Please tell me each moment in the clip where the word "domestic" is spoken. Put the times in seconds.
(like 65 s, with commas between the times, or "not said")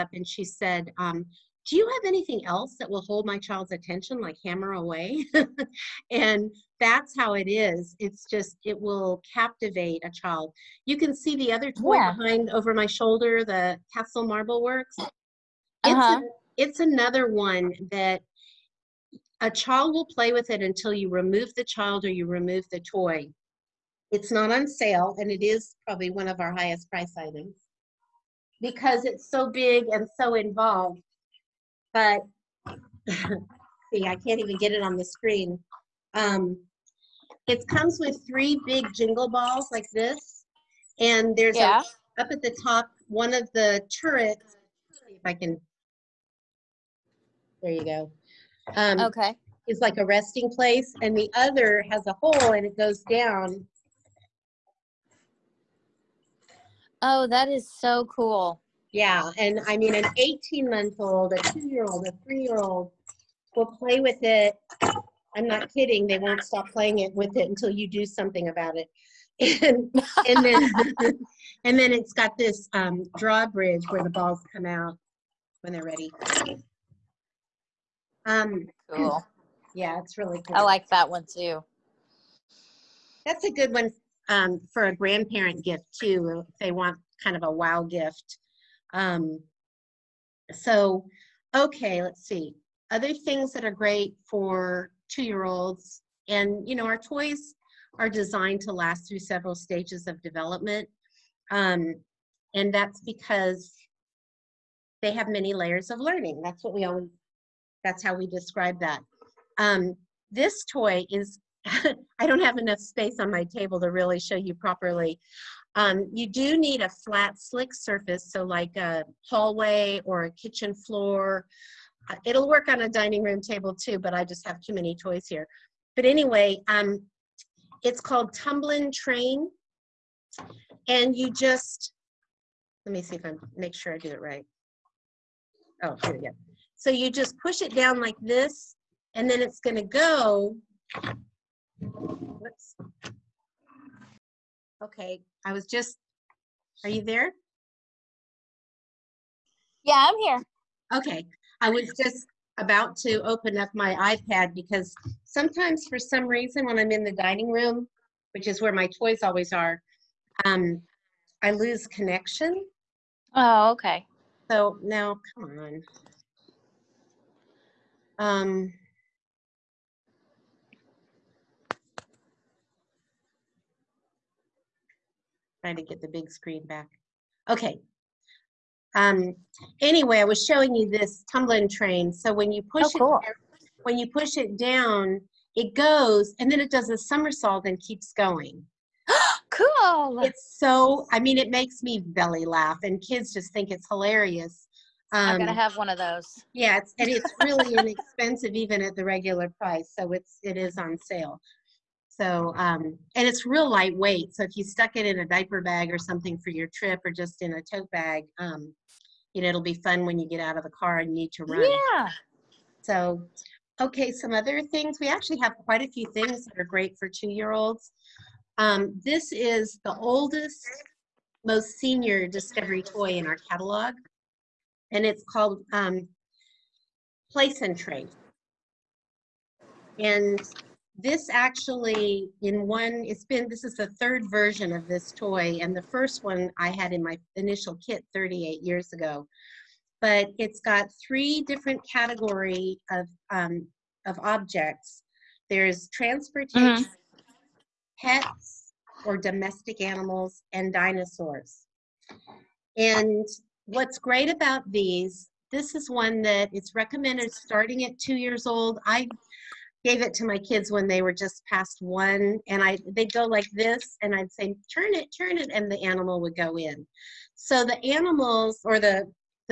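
249 s.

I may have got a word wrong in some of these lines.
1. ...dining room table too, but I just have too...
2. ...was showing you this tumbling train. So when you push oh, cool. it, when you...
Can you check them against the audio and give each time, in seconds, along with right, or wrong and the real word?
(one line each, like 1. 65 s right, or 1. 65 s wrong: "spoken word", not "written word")
1. 122 s right
2. 180 s right.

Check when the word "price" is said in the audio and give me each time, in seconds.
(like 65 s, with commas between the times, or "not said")
26 s, 199 s.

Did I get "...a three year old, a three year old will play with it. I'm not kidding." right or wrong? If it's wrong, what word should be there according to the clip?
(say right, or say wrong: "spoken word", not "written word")
wrong: "two", not "three".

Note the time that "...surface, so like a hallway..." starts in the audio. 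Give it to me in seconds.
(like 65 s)
117 s.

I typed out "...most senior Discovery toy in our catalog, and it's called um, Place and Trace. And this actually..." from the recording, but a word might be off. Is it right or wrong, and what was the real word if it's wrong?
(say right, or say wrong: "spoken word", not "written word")
right.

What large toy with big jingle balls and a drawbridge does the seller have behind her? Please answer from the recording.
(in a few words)
castle marble works.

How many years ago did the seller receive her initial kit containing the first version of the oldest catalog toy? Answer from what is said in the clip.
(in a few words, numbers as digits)
38.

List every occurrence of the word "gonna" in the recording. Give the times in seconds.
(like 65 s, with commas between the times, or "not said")
139 s, 195 s.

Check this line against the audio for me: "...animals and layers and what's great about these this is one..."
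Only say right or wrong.
wrong.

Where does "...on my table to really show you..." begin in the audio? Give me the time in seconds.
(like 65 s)
113 s.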